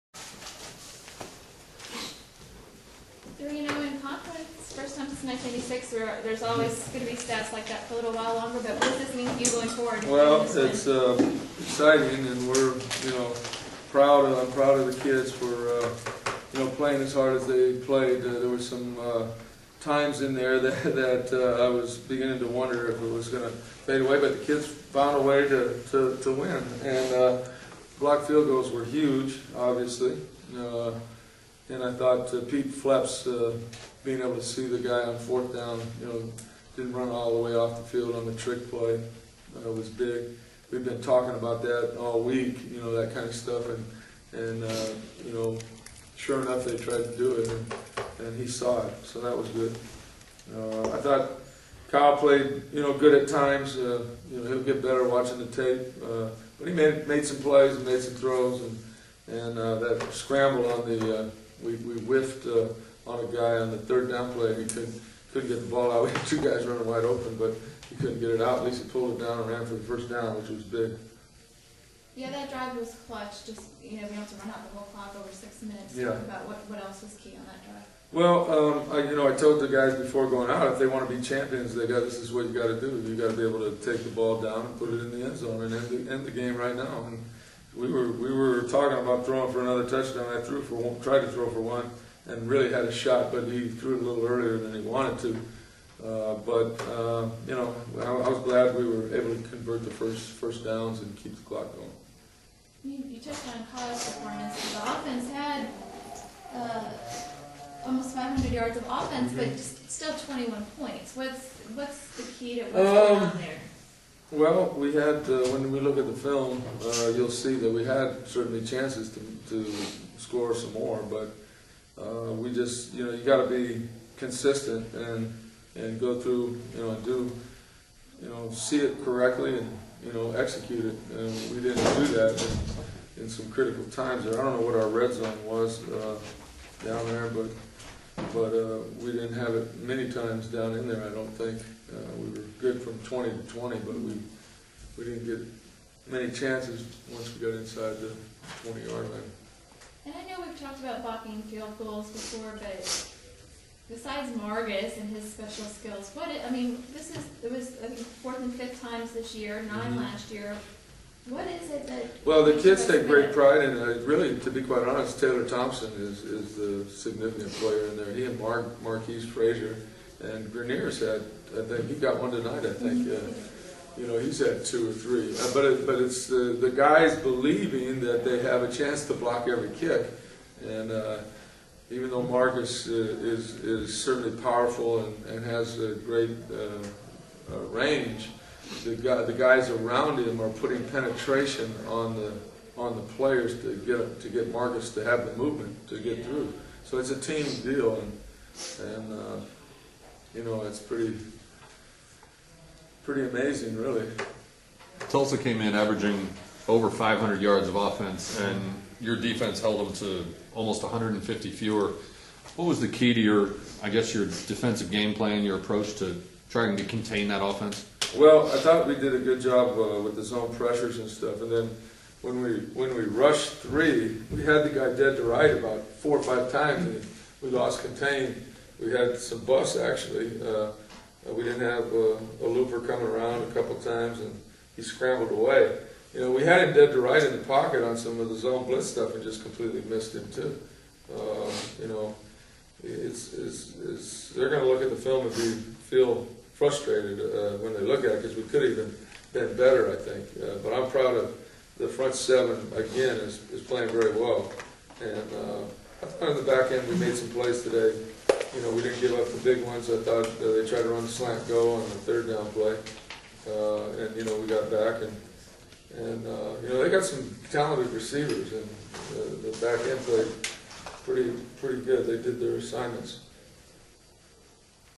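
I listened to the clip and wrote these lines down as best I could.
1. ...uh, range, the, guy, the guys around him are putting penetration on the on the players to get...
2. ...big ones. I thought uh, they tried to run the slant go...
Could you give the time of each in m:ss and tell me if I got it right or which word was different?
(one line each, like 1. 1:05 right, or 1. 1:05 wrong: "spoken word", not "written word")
1. 3:07 right
2. 4:19 right.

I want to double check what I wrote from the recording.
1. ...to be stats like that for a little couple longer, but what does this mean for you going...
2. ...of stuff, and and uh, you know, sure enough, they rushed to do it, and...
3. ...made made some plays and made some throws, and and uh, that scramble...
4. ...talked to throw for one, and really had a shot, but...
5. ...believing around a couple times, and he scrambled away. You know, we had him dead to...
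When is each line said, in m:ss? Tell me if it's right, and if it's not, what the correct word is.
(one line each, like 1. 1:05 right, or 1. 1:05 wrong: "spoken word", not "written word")
1. 0:07 wrong: "while", not "couple"
2. 0:43 wrong: "tried", not "rushed"
3. 0:56 right
4. 1:31 wrong: "tried", not "talked"
5. 3:52 wrong: "coming", not "believing".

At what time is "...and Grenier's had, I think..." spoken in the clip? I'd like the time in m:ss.
2:50.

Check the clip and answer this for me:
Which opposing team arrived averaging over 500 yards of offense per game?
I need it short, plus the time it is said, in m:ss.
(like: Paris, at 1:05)
Tulsa, at 3:25.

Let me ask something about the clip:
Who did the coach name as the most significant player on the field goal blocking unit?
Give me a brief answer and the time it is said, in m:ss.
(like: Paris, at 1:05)
Taylor Thompson, at 2:45.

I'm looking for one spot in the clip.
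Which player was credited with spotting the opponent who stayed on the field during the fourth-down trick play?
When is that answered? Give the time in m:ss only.
0:32.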